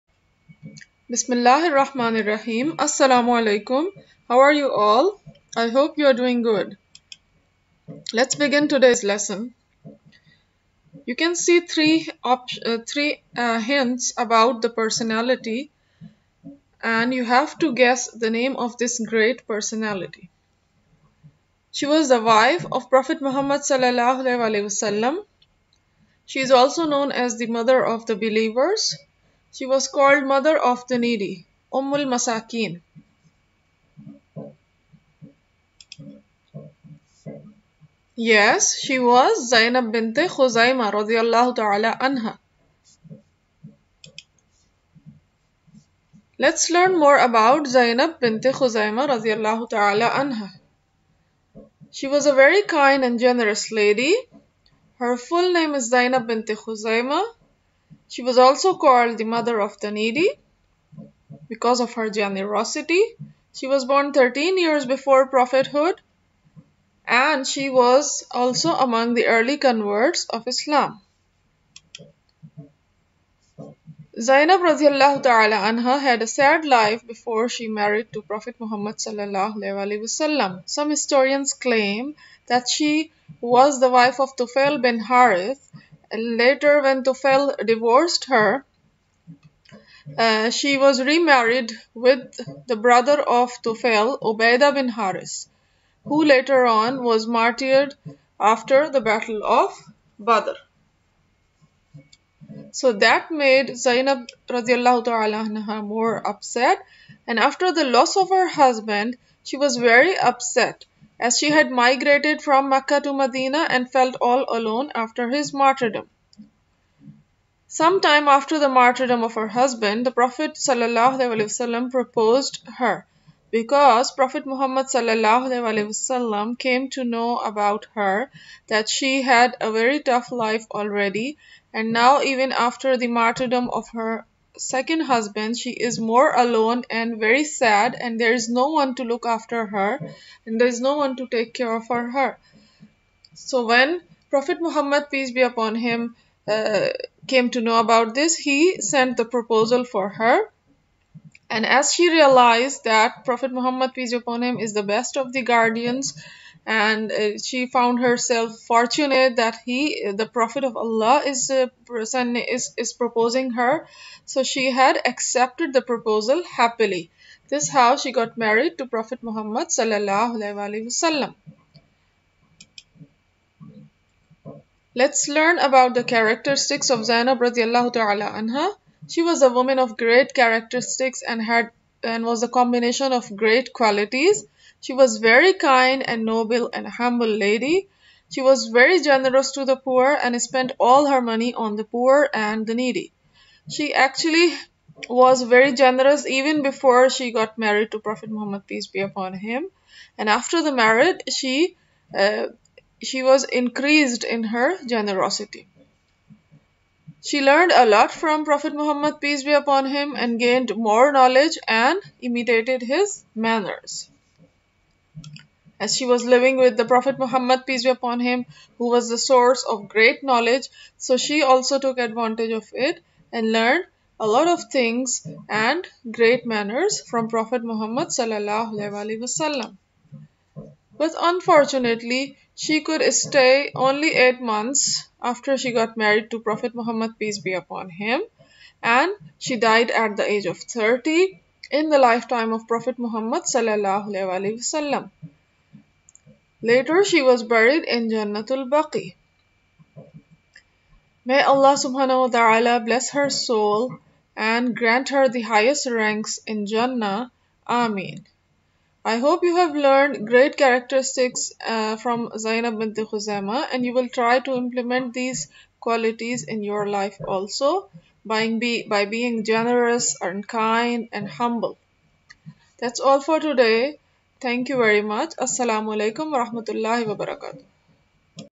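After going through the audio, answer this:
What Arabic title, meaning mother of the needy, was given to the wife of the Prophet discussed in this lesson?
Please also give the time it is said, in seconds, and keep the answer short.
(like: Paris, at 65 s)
Ummul Masakin, at 31 s.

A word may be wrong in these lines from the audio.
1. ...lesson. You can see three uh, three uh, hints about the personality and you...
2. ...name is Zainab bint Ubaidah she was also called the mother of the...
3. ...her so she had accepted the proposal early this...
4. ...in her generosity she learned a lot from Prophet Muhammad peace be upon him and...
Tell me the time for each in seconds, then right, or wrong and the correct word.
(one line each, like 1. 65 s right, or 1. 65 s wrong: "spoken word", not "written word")
1. 9 s right
2. 55 s wrong: "Khuzaima", not "Ubaidah"
3. 163 s wrong: "happily", not "early"
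4. 204 s right.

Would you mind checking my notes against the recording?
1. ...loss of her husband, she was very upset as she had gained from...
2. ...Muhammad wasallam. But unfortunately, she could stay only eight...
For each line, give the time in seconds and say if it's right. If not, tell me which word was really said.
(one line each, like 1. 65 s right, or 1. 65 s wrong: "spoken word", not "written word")
1. 107 s wrong: "migrated", not "gained"
2. 227 s right.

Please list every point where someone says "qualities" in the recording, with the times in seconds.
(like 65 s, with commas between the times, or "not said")
183 s, 265 s.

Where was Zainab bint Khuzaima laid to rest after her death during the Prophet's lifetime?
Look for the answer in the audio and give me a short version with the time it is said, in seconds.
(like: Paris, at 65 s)
Jannatul Baqi, at 248 s.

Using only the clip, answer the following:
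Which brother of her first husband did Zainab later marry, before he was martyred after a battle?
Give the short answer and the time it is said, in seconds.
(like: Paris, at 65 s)
Ubaidah bin Haris, at 94 s.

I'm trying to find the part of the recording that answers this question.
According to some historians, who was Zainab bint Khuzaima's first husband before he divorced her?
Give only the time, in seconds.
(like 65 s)
84 s.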